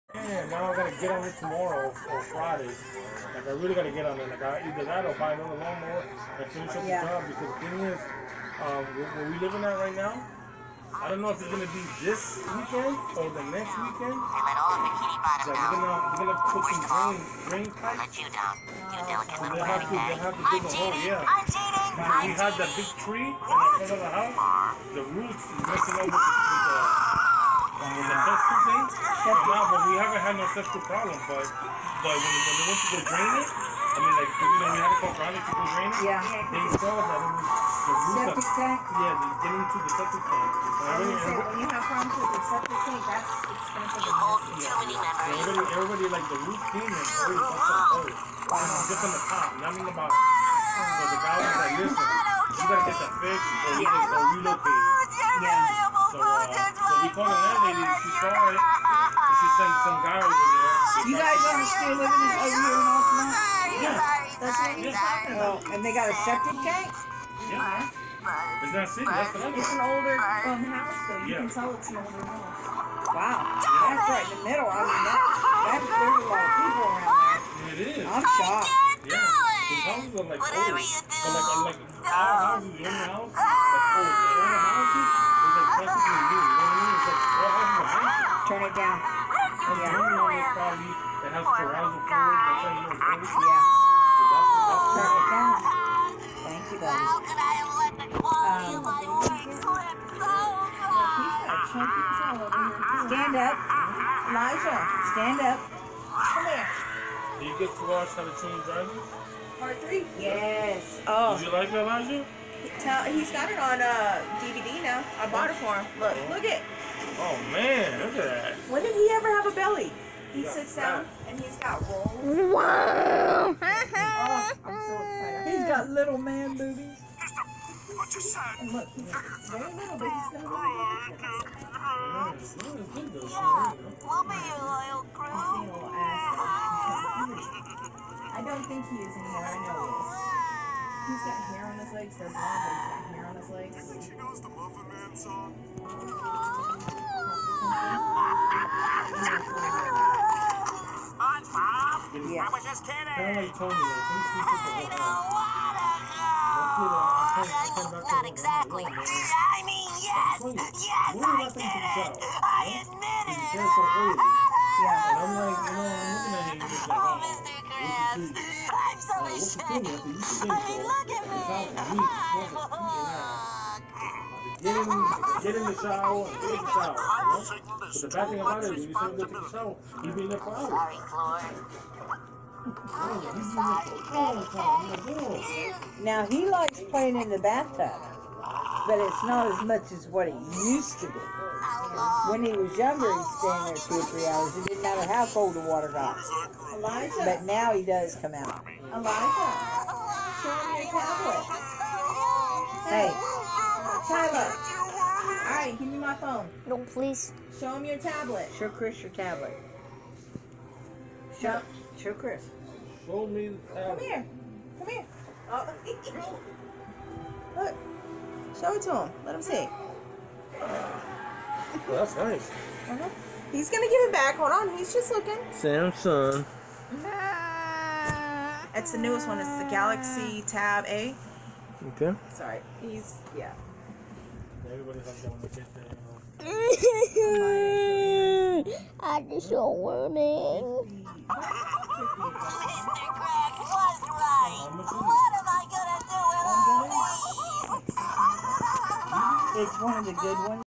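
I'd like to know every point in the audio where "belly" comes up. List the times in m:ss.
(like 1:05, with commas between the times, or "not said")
1:59.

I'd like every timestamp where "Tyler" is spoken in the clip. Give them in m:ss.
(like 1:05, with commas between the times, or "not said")
3:24.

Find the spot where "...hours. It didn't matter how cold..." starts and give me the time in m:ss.
3:14.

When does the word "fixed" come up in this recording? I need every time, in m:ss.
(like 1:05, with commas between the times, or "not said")
0:53.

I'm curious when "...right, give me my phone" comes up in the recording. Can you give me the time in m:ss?
3:25.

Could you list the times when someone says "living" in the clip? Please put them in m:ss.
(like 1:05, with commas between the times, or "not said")
0:09, 1:01.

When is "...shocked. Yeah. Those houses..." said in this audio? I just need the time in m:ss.
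1:18.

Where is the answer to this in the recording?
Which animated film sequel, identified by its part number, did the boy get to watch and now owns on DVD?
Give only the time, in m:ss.
1:48.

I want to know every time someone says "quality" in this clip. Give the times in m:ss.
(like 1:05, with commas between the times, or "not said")
1:38.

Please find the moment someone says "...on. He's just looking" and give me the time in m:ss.
3:44.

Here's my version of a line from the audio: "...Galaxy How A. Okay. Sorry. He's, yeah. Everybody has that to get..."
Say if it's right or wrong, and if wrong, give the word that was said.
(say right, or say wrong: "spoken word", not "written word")
wrong: "Tab", not "How".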